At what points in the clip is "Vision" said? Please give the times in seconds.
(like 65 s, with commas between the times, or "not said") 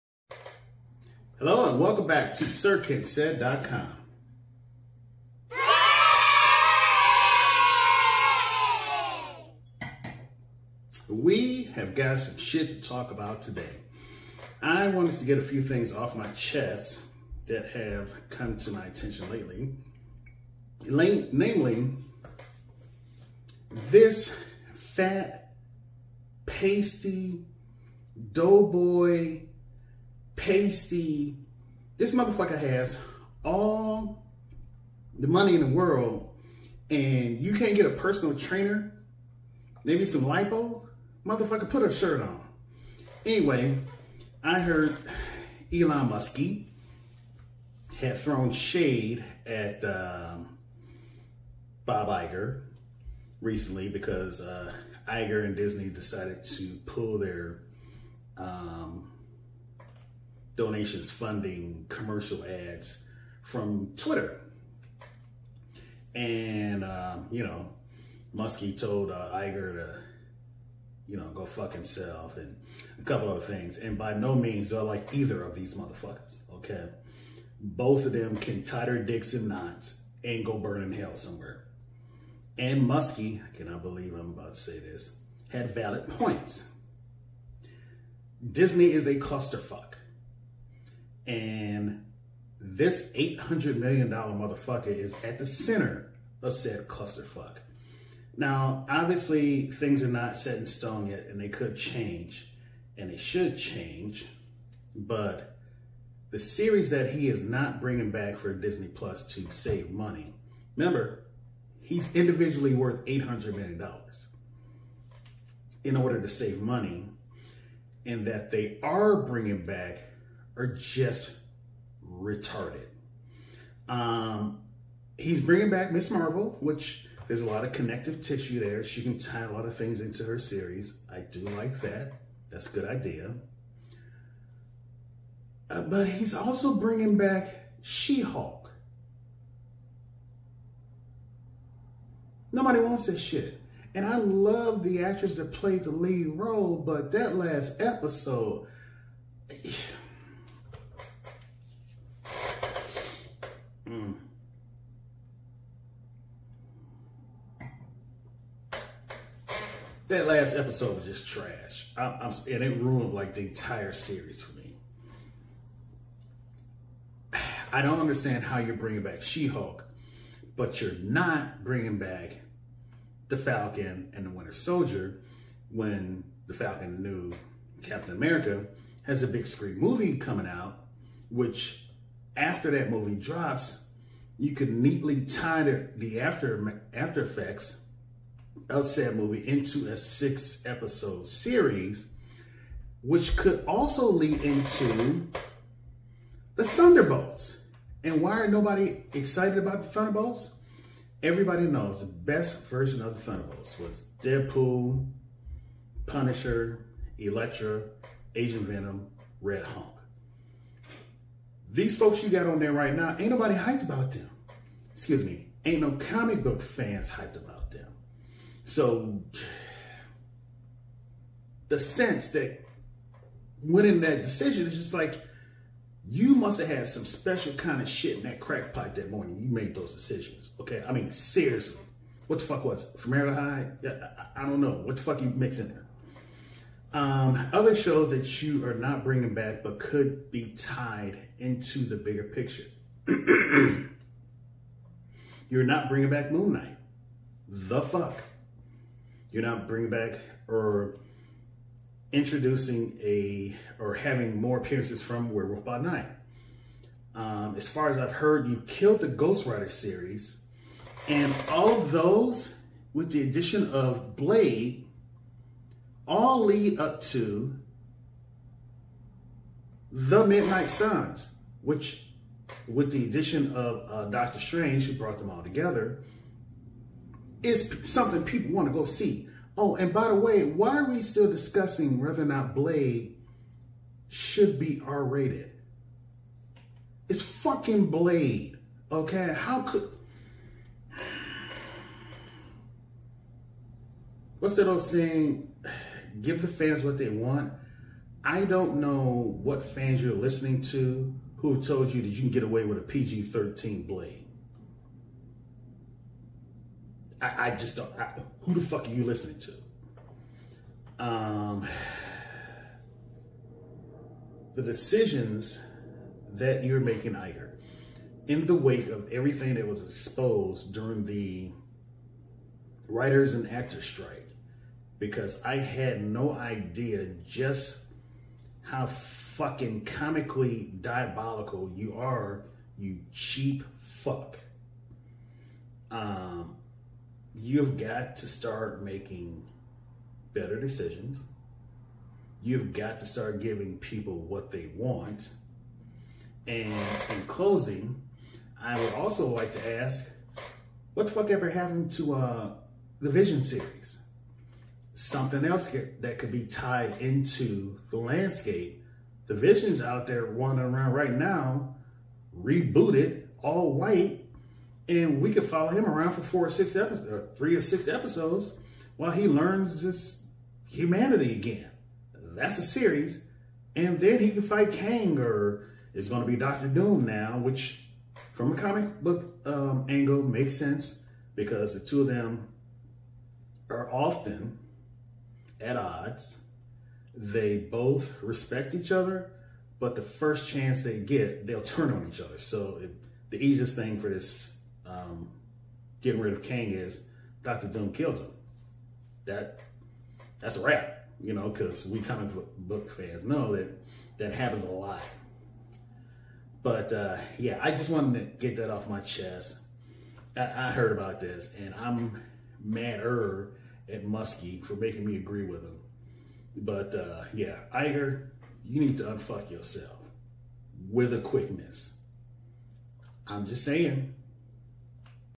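353 s, 359 s.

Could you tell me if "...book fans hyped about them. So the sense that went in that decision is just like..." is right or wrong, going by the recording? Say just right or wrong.
right.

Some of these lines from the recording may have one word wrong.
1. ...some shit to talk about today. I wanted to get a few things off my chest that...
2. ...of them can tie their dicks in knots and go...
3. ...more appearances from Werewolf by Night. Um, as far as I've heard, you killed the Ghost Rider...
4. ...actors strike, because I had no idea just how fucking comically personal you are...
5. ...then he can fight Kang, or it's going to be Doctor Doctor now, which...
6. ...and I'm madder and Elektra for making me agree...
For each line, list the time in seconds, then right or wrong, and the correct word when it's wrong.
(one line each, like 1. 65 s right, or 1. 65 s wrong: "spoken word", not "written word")
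1. 12 s right
2. 78 s right
3. 254 s right
4. 323 s wrong: "diabolical", not "personal"
5. 373 s wrong: "Doom", not "Doctor"
6. 411 s wrong: "Muskie", not "Elektra".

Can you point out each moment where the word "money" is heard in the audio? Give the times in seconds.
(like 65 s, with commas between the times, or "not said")
35 s, 109 s, 116 s.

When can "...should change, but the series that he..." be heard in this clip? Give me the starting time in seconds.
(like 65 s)
103 s.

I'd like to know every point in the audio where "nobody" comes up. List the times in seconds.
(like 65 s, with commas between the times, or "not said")
142 s, 198 s, 213 s.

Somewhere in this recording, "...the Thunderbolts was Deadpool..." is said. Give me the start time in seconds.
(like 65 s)
203 s.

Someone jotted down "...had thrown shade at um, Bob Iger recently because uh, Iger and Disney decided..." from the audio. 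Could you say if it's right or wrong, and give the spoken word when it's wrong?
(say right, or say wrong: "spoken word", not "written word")
right.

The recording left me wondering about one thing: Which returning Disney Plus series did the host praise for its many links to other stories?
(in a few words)
Miss Marvel.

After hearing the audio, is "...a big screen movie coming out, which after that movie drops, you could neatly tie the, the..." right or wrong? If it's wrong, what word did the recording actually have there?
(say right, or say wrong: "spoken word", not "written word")
right.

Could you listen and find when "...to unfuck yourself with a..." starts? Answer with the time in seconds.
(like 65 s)
418 s.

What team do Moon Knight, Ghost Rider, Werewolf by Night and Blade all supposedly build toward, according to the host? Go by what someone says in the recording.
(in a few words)
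Midnight Suns.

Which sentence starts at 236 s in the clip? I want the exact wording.
Um, other shows that you are not bringing back but could be tied into the bigger picture.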